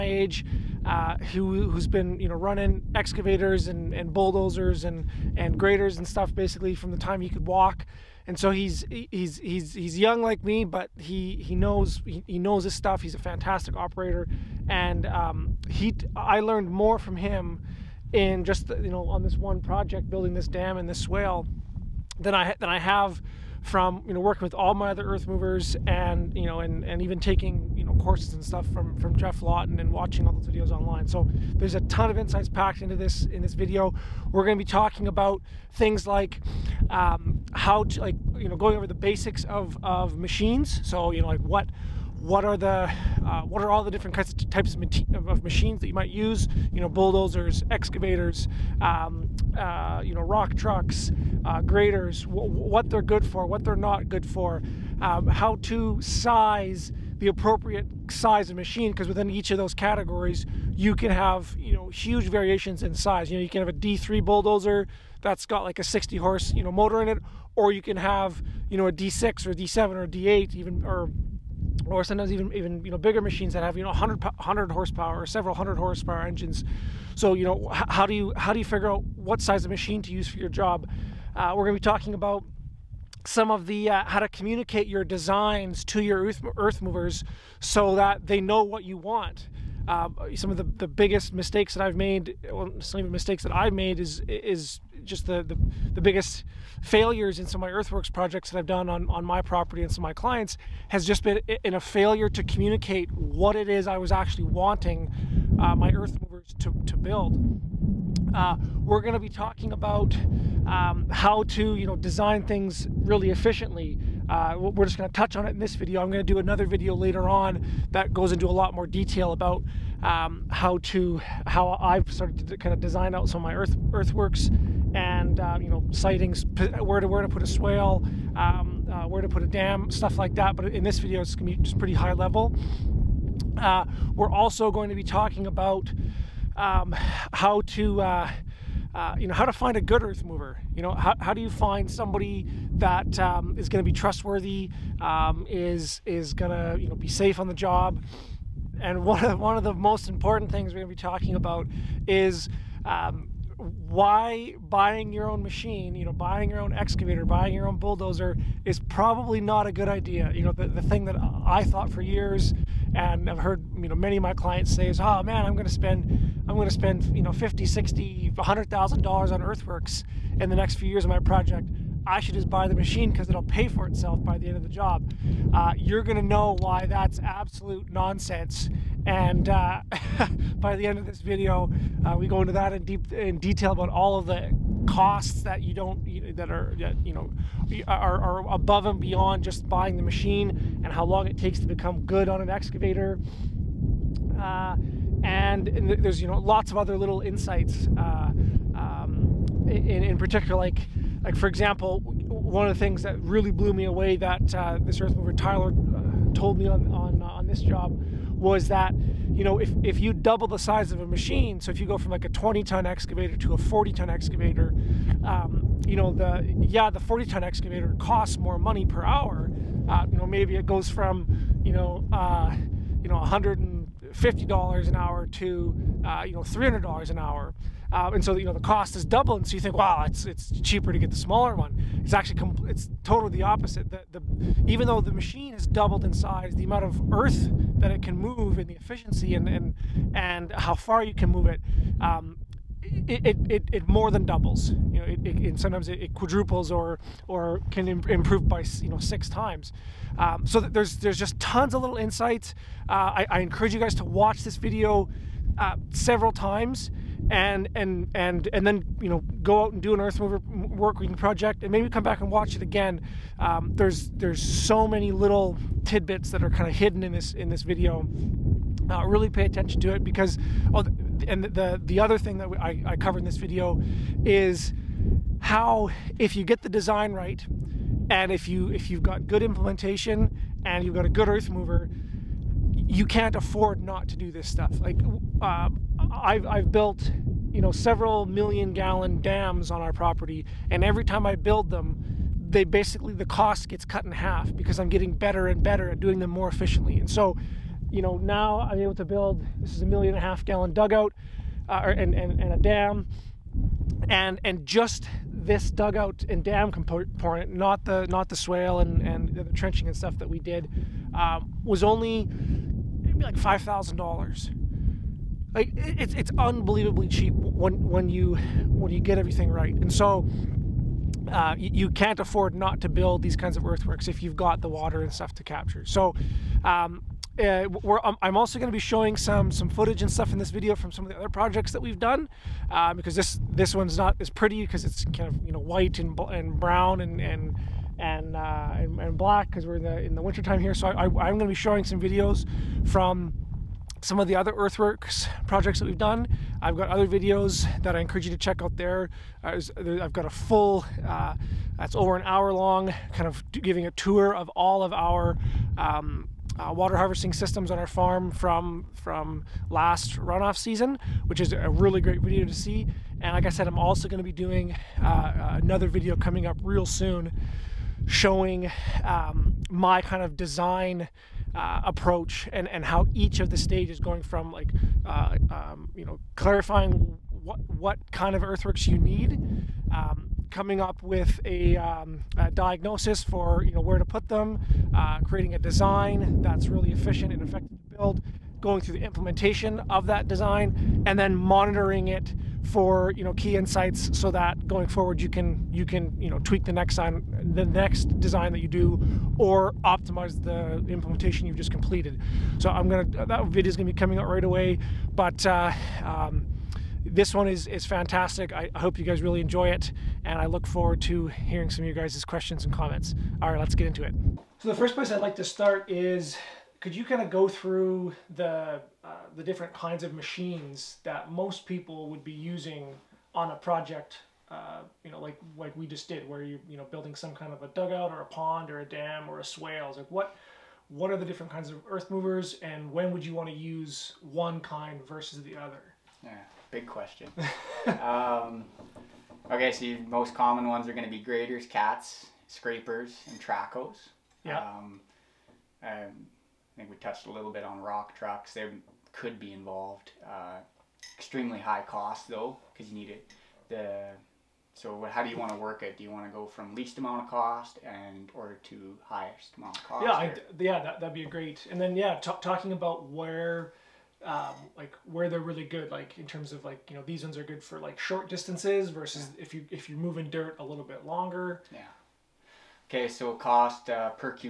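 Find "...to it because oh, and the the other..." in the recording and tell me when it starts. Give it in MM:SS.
04:29.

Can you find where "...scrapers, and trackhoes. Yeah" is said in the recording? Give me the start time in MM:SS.
07:22.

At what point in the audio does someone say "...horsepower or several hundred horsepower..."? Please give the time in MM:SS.
01:14.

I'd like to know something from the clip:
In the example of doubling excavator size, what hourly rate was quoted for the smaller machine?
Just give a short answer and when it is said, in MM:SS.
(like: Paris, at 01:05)
$150 an hour, at 03:43.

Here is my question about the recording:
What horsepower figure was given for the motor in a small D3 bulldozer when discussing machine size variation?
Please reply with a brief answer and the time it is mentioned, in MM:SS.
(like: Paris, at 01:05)
60, at 01:05.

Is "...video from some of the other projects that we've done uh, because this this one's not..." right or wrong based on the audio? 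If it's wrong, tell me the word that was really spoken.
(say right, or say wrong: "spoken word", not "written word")
right.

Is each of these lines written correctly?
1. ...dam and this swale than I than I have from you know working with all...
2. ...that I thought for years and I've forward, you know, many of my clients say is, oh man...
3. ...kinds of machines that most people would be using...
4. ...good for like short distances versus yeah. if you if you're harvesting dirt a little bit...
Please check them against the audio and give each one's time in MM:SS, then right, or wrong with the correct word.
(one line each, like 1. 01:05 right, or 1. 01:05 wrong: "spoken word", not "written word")
1. 00:20 right
2. 02:41 wrong: "heard", not "forward"
3. 06:59 right
4. 07:47 wrong: "moving", not "harvesting".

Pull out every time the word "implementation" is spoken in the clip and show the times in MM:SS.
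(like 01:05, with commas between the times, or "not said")
04:39, 06:29, 06:40.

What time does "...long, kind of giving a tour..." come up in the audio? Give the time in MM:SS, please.
05:52.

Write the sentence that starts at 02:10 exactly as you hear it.
But in this video, it's going to be just pretty high level.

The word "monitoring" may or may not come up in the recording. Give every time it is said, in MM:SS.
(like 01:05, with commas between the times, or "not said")
06:31.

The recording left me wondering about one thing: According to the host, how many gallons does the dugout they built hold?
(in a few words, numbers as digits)
1.5 million gallons.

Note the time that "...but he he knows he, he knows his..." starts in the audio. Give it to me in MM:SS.
00:10.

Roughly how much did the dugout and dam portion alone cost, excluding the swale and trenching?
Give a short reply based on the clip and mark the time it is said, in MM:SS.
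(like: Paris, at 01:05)
$5,000, at 05:13.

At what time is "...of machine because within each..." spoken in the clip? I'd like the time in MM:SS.
00:58.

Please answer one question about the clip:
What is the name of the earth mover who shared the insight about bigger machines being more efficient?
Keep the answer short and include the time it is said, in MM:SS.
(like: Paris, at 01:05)
Tyler, at 03:25.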